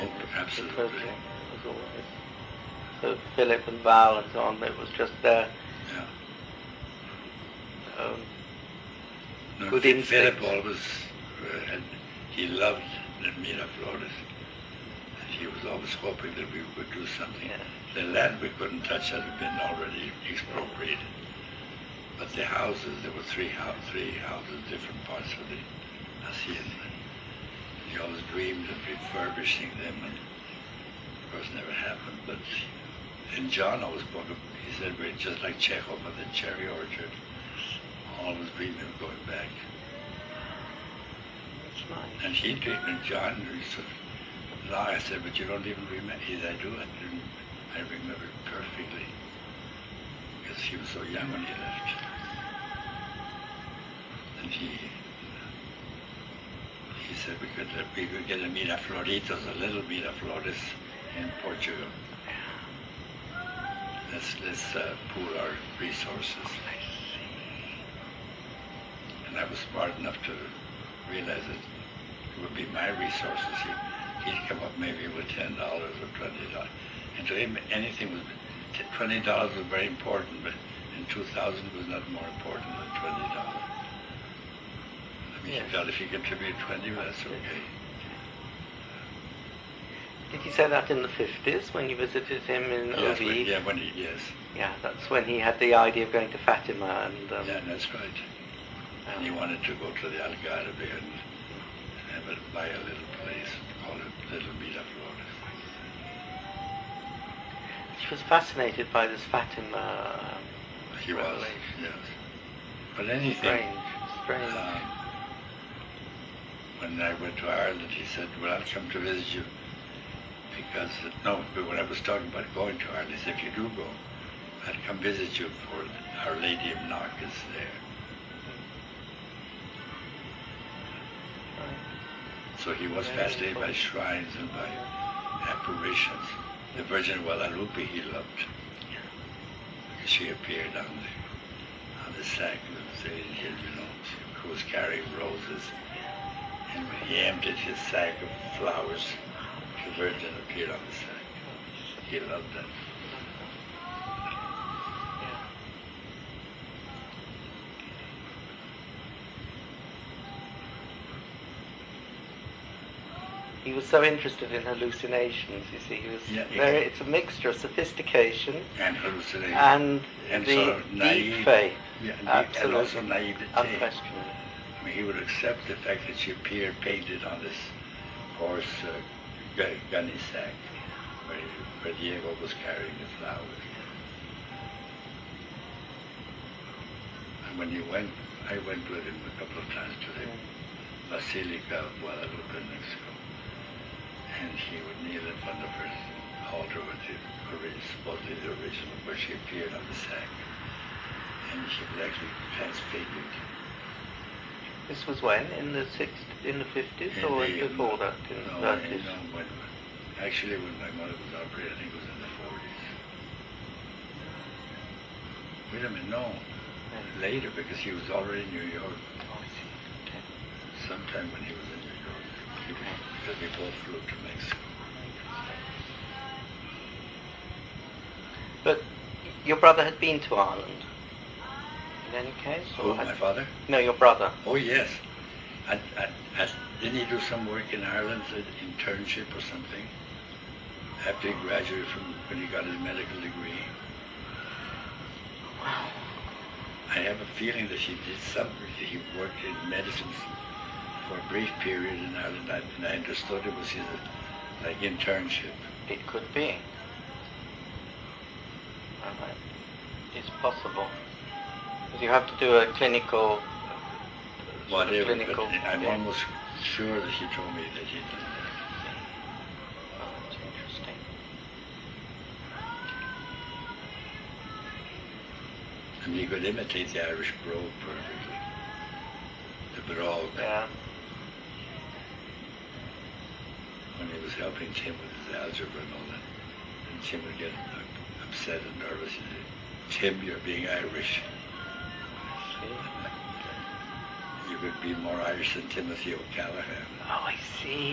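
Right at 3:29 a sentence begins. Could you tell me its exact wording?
no, when, actually, when my mother was operated, I think it was in the forties.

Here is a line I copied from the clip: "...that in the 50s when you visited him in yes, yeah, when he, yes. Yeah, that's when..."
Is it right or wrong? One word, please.
right.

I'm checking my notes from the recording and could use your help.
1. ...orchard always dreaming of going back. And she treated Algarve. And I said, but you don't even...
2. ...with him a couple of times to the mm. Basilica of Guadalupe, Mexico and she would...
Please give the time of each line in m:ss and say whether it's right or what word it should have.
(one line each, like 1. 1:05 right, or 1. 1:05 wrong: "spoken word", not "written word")
1. 0:36 wrong: "John", not "Algarve"
2. 3:08 right.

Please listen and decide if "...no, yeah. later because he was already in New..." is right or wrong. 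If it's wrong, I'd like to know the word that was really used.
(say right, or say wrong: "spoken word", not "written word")
right.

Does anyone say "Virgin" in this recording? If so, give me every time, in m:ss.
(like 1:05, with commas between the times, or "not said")
2:16, 2:29.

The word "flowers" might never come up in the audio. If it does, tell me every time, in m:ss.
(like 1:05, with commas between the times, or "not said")
2:28, 3:03.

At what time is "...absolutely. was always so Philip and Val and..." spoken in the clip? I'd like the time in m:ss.
0:00.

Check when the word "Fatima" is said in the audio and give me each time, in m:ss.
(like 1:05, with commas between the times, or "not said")
1:36, 1:49.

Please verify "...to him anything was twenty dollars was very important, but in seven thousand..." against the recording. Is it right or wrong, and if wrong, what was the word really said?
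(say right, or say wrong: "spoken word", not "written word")
wrong: "two", not "seven".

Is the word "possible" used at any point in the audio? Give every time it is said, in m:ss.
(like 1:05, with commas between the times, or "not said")
4:20.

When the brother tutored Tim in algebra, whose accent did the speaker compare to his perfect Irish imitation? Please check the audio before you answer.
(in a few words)
Timothy O'Callaghan.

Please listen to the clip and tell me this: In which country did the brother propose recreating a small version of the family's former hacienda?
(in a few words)
Portugal.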